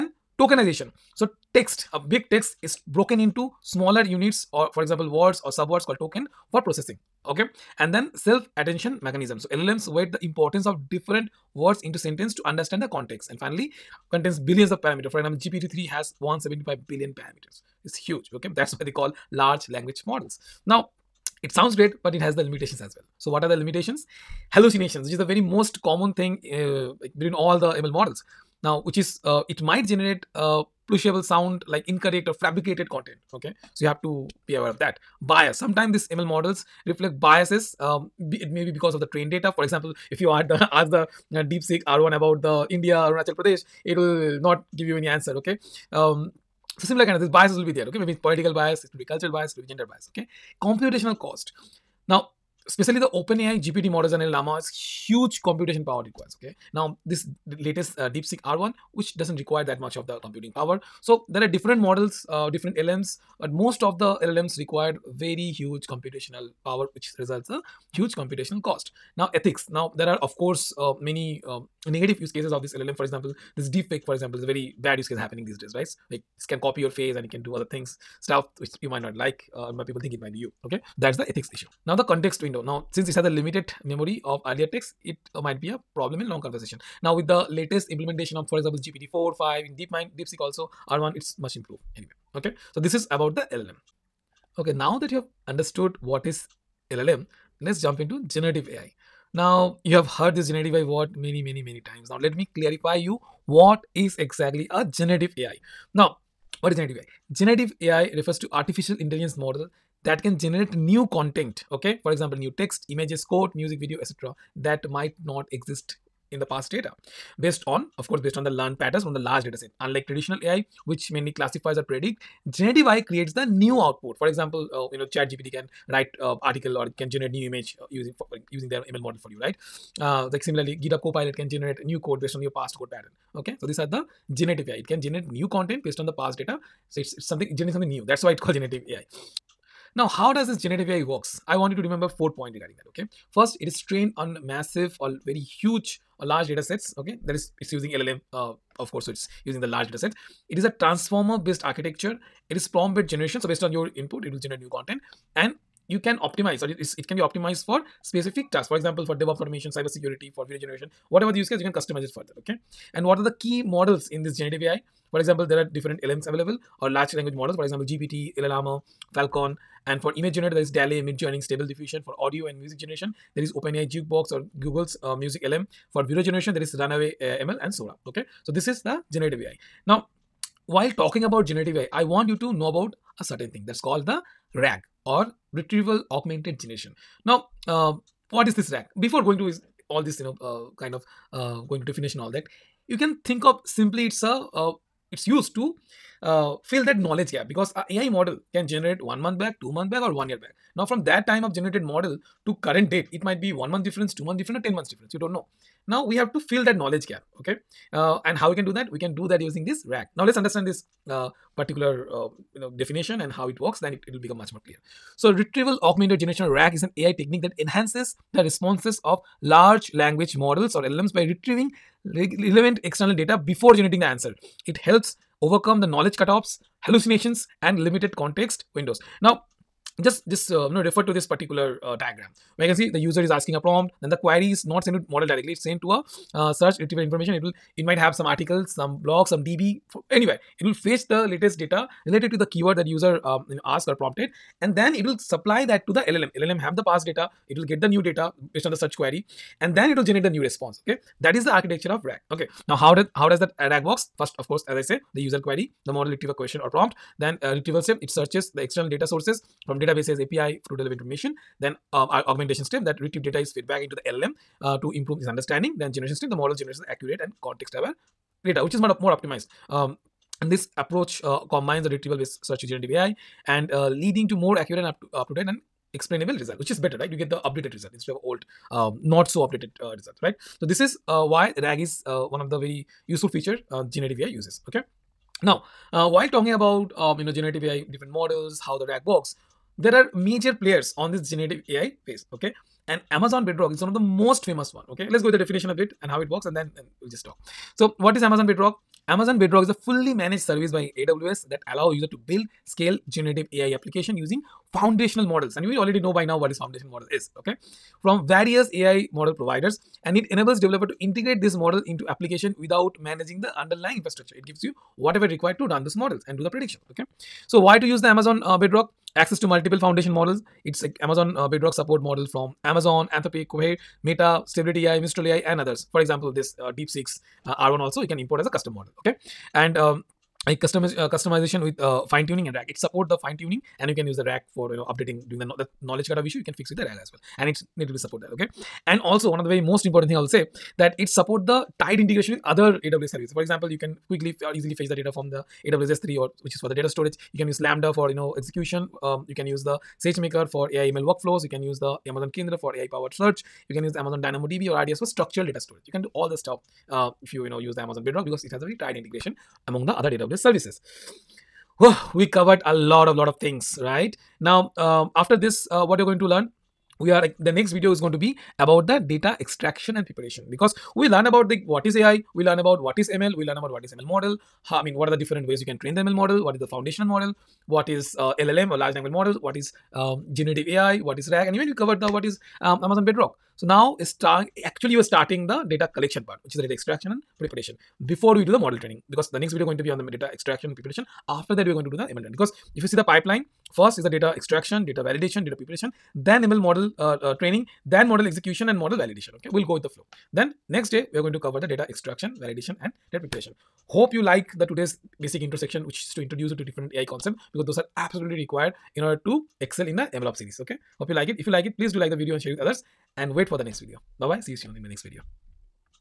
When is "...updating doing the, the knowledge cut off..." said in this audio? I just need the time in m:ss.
5:34.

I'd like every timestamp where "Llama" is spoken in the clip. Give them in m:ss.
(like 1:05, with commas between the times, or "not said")
0:54, 2:48.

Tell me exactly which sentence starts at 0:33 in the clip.
Okay, so you have to be aware of that bias.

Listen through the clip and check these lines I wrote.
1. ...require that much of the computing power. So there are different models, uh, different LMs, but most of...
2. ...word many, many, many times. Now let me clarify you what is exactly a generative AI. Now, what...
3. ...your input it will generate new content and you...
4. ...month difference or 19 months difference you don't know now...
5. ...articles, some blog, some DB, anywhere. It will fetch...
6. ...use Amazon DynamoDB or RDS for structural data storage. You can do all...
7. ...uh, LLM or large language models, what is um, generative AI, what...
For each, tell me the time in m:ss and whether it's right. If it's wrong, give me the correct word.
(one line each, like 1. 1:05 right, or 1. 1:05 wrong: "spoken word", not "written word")
1. 0:59 right
2. 1:40 right
3. 2:33 right
4. 3:24 wrong: "10", not "19"
5. 3:58 right
6. 5:53 right
7. 6:18 right.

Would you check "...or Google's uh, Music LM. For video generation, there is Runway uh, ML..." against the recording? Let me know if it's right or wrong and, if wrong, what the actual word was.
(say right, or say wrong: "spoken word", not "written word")
right.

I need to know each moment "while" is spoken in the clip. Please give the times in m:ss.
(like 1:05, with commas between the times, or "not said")
3:00, 4:46.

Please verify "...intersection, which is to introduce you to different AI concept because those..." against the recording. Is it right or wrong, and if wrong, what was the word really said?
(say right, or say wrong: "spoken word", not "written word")
right.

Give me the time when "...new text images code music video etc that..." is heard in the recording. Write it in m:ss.
1:52.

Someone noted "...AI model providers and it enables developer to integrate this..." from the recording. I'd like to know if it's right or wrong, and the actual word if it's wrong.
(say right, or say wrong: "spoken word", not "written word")
right.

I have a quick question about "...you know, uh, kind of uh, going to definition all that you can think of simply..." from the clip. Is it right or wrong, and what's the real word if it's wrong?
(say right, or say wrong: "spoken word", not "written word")
right.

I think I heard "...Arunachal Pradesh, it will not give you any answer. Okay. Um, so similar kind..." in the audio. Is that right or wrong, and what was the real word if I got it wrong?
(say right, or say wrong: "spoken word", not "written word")
right.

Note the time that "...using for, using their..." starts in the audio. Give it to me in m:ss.
2:07.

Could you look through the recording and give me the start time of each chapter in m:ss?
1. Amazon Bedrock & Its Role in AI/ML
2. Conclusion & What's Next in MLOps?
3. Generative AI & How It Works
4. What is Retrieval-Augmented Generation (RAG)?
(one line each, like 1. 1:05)
1. 4:49
2. 6:02
3. 1:37
4. 3:02.